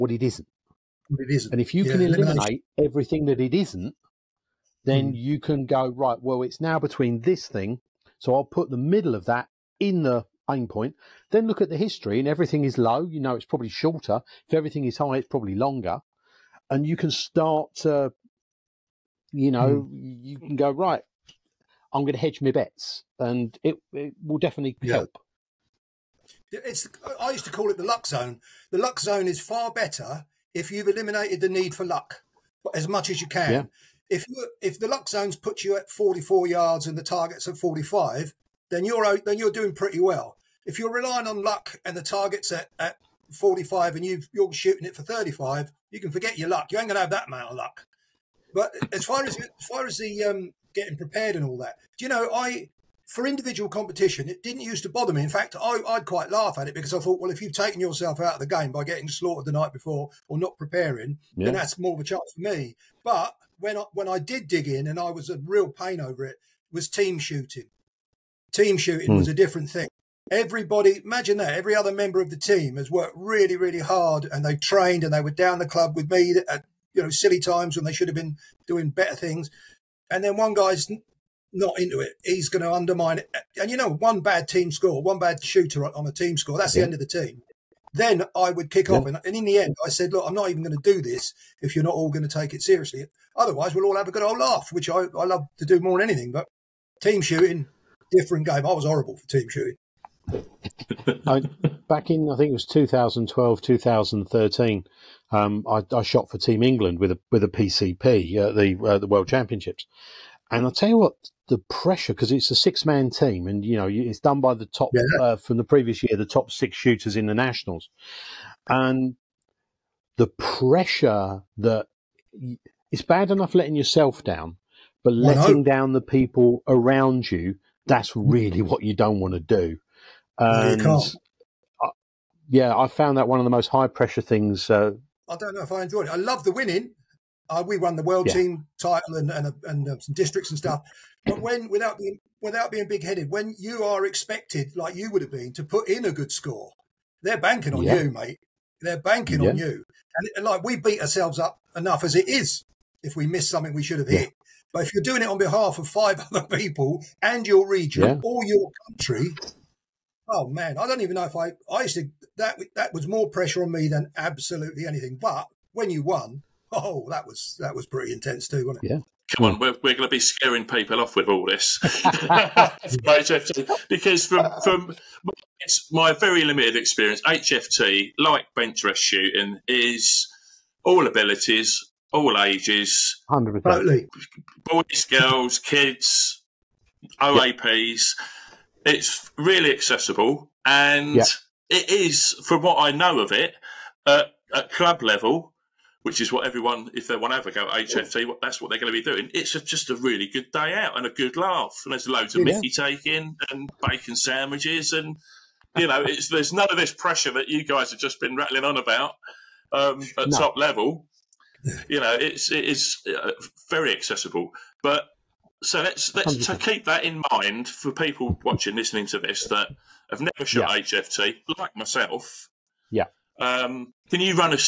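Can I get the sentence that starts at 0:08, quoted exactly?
So I'll put the middle of that in the aim point.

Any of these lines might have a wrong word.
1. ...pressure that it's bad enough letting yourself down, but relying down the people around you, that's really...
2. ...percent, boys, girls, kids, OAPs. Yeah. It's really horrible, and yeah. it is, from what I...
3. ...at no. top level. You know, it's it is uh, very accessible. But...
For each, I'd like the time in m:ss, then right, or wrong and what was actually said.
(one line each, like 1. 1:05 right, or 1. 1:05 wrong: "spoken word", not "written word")
1. 2:00 wrong: "letting", not "relying"
2. 3:03 wrong: "accessible", not "horrible"
3. 3:30 right.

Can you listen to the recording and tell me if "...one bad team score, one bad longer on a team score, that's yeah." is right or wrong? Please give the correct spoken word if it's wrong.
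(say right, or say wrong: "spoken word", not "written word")
wrong: "shooter", not "longer".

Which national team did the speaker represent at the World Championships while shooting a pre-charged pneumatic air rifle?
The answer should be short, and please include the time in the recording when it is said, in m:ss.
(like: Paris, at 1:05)
Team England, at 1:46.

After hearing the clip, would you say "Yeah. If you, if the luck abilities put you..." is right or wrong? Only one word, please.
wrong.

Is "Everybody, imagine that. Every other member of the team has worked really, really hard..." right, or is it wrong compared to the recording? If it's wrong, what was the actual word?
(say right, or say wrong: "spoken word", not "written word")
right.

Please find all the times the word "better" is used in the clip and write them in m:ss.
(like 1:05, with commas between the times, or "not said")
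0:29, 1:18.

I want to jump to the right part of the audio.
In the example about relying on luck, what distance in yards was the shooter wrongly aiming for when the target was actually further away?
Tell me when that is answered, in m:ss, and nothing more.
0:45.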